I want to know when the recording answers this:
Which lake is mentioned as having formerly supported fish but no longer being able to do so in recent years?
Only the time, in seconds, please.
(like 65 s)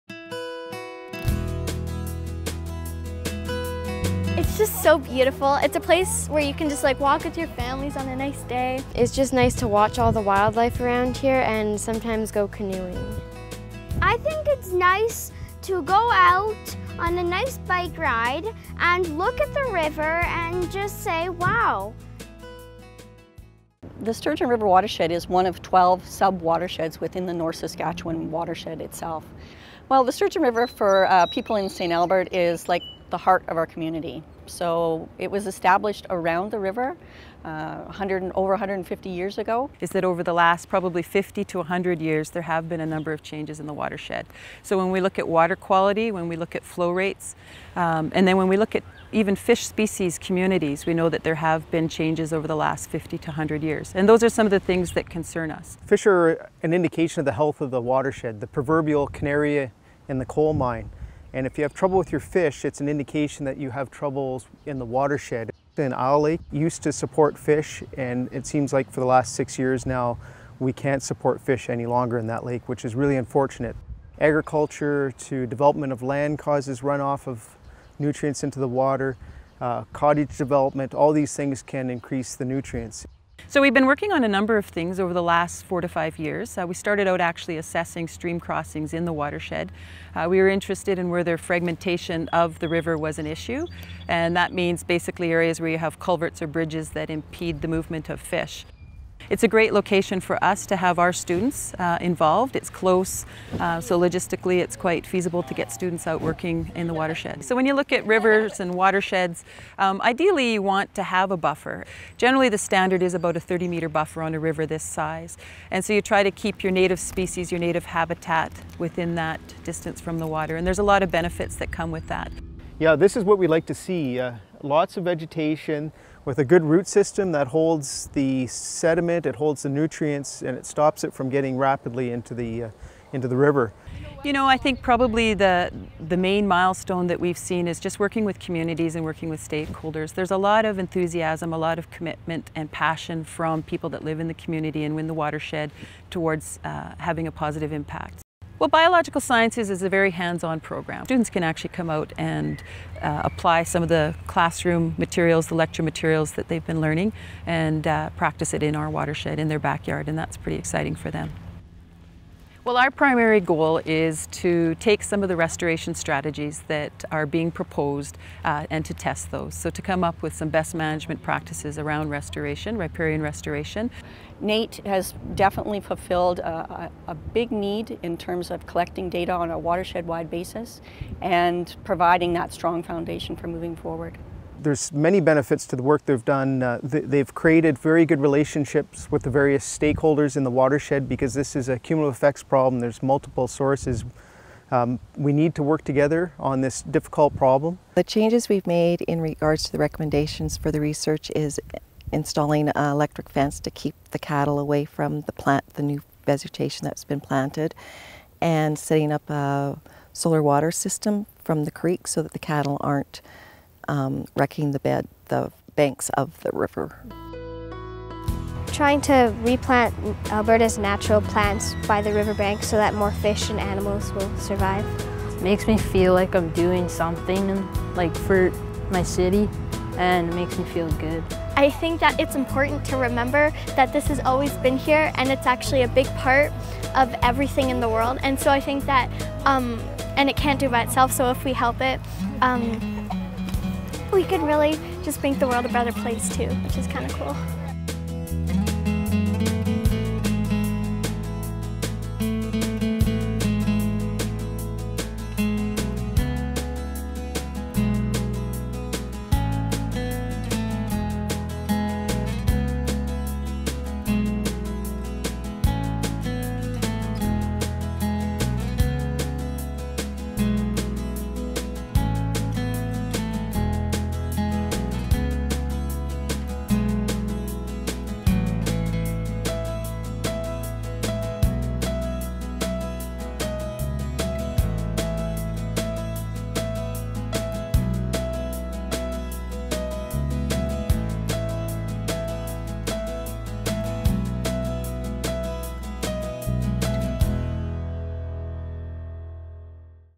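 65 s.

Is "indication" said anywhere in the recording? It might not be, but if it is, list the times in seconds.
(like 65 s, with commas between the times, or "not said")
56 s, 62 s.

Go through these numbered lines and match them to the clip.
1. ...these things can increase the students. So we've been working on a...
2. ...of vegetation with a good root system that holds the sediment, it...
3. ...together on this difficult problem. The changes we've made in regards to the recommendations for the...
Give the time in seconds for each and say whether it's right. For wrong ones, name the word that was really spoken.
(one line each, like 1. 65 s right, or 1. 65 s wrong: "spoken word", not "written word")
1. 81 s wrong: "nutrients", not "students"
2. 124 s right
3. 195 s right.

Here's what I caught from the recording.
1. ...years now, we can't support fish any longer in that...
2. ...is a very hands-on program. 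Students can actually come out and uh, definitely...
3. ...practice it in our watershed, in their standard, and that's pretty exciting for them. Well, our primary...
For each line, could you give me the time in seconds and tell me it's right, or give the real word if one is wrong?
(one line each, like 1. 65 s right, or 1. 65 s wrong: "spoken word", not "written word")
1. 69 s right
2. 149 s wrong: "apply", not "definitely"
3. 158 s wrong: "backyard", not "standard".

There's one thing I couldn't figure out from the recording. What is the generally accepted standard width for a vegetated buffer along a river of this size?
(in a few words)
30 meters.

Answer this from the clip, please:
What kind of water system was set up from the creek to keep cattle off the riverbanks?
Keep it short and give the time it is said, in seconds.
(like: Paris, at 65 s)
Solar water system, at 210 s.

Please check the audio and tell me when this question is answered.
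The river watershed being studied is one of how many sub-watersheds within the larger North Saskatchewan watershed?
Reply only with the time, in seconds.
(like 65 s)
25 s.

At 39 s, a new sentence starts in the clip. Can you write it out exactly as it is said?
Is that over the last probably 50 to 100 years there have been a number of changes in the watershed.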